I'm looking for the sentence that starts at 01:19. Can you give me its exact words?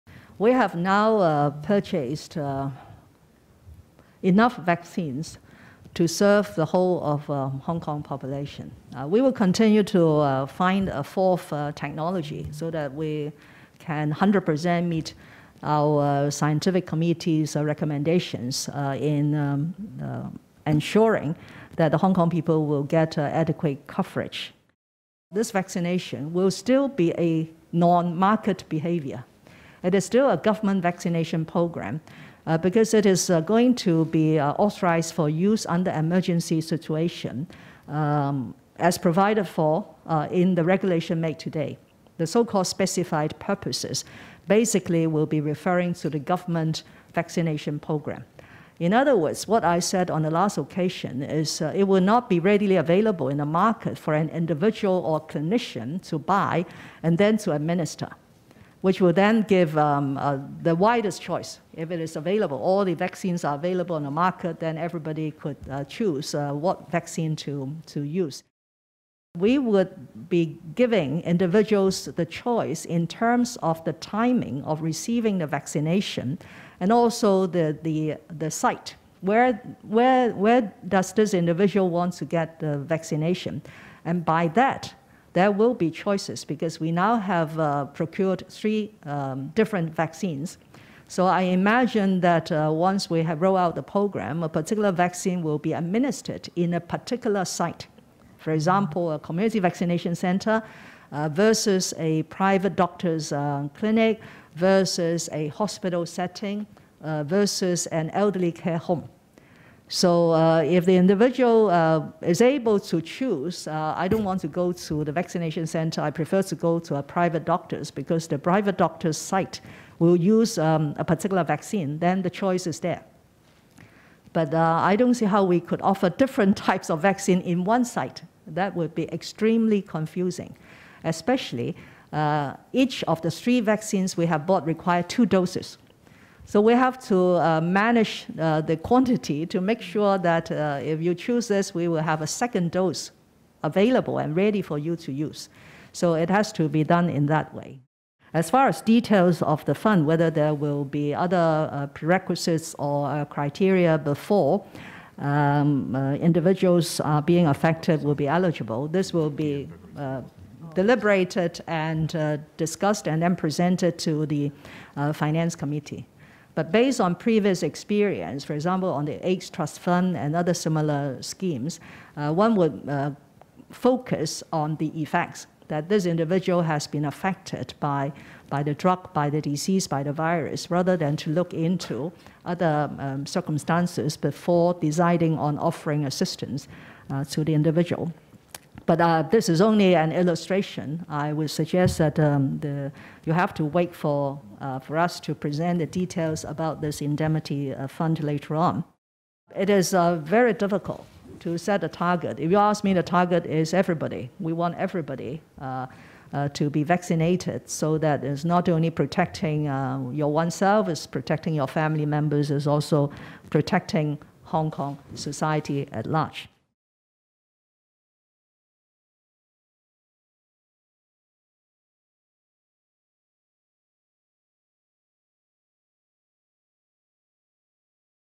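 Where, where, where does this individual want to get the vaccination?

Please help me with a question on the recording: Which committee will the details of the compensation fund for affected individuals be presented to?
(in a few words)
Finance Committee.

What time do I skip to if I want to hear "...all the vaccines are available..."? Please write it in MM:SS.
01:02.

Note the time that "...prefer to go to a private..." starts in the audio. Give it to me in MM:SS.
01:56.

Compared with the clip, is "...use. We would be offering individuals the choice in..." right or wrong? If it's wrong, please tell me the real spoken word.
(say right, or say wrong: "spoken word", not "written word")
wrong: "giving", not "offering".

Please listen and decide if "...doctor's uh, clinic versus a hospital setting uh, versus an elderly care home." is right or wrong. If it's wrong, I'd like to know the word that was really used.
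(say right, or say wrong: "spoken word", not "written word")
right.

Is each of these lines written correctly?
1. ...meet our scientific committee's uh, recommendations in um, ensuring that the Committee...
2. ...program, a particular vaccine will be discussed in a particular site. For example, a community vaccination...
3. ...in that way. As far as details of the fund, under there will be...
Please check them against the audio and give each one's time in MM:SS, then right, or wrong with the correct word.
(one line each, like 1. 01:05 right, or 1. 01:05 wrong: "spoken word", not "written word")
1. 00:14 wrong: "Hong", not "Committee"
2. 01:33 wrong: "administered", not "discussed"
3. 02:27 wrong: "whether", not "under".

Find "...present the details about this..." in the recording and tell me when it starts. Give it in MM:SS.
03:15.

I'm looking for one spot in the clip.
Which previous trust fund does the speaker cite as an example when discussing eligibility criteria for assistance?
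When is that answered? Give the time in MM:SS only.
02:49.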